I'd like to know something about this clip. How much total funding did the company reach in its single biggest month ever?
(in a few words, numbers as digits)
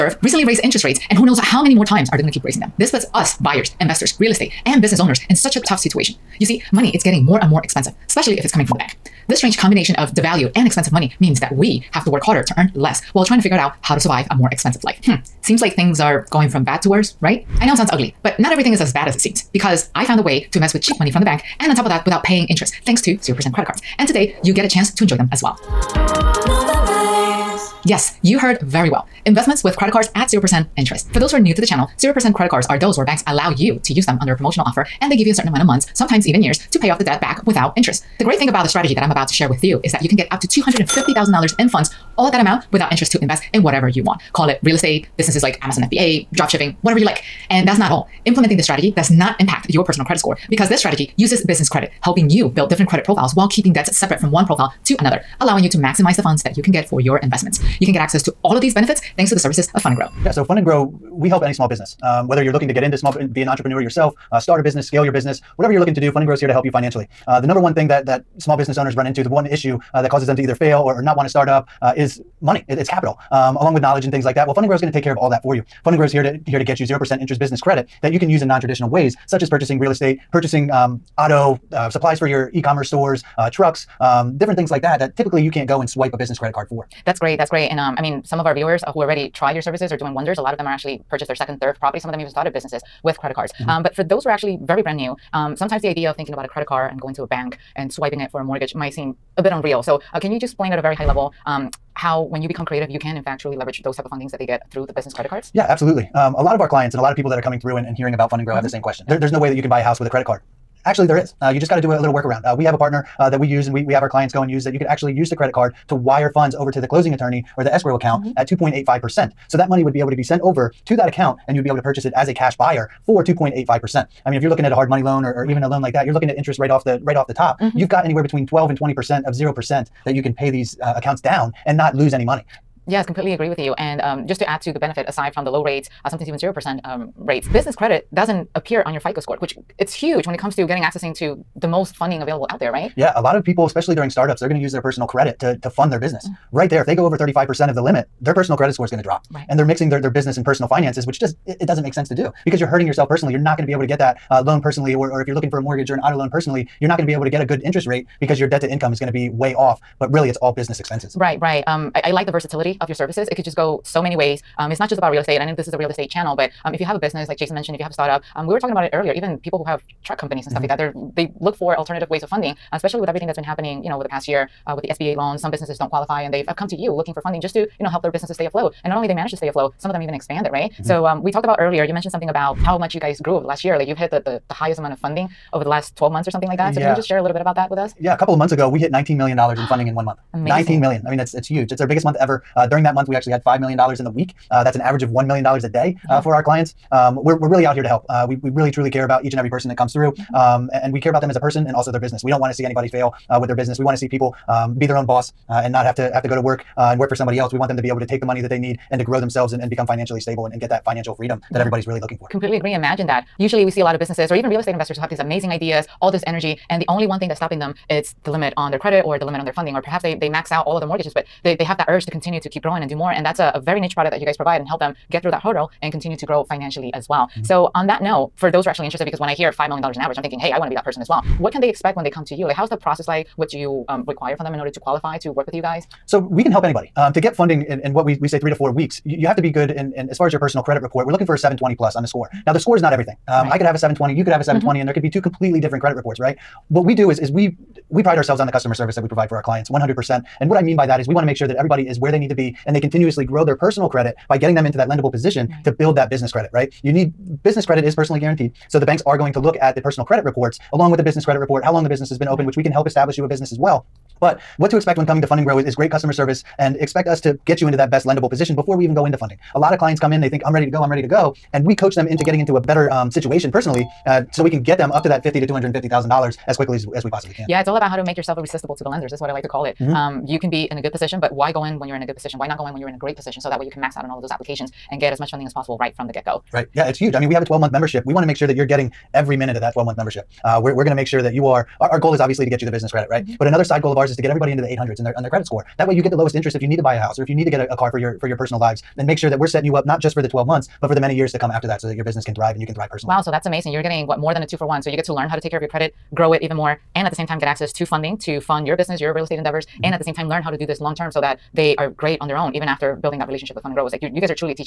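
$19 million.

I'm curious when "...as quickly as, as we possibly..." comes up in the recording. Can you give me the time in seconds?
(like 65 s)
276 s.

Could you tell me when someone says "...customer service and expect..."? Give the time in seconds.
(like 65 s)
265 s.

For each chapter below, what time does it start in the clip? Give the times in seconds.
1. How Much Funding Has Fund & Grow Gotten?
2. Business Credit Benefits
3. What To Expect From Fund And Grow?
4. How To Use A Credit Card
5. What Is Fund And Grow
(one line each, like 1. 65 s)
1. 182 s
2. 137 s
3. 228 s
4. 101 s
5. 60 s.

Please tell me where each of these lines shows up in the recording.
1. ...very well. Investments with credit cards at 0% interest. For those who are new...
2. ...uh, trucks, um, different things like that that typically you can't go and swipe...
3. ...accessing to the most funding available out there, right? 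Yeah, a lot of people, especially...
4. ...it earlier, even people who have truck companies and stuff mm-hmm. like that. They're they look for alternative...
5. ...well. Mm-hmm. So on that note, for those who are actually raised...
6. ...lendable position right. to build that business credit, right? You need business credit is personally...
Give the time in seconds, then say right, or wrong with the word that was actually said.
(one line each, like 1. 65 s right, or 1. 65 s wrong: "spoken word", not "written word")
1. 28 s right
2. 83 s right
3. 140 s right
4. 168 s right
5. 227 s wrong: "interested", not "raised"
6. 254 s right.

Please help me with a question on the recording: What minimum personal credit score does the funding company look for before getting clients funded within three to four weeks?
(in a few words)
720.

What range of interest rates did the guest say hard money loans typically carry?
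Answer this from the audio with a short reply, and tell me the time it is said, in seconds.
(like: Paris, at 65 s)
12 to 20 percent, at 128 s.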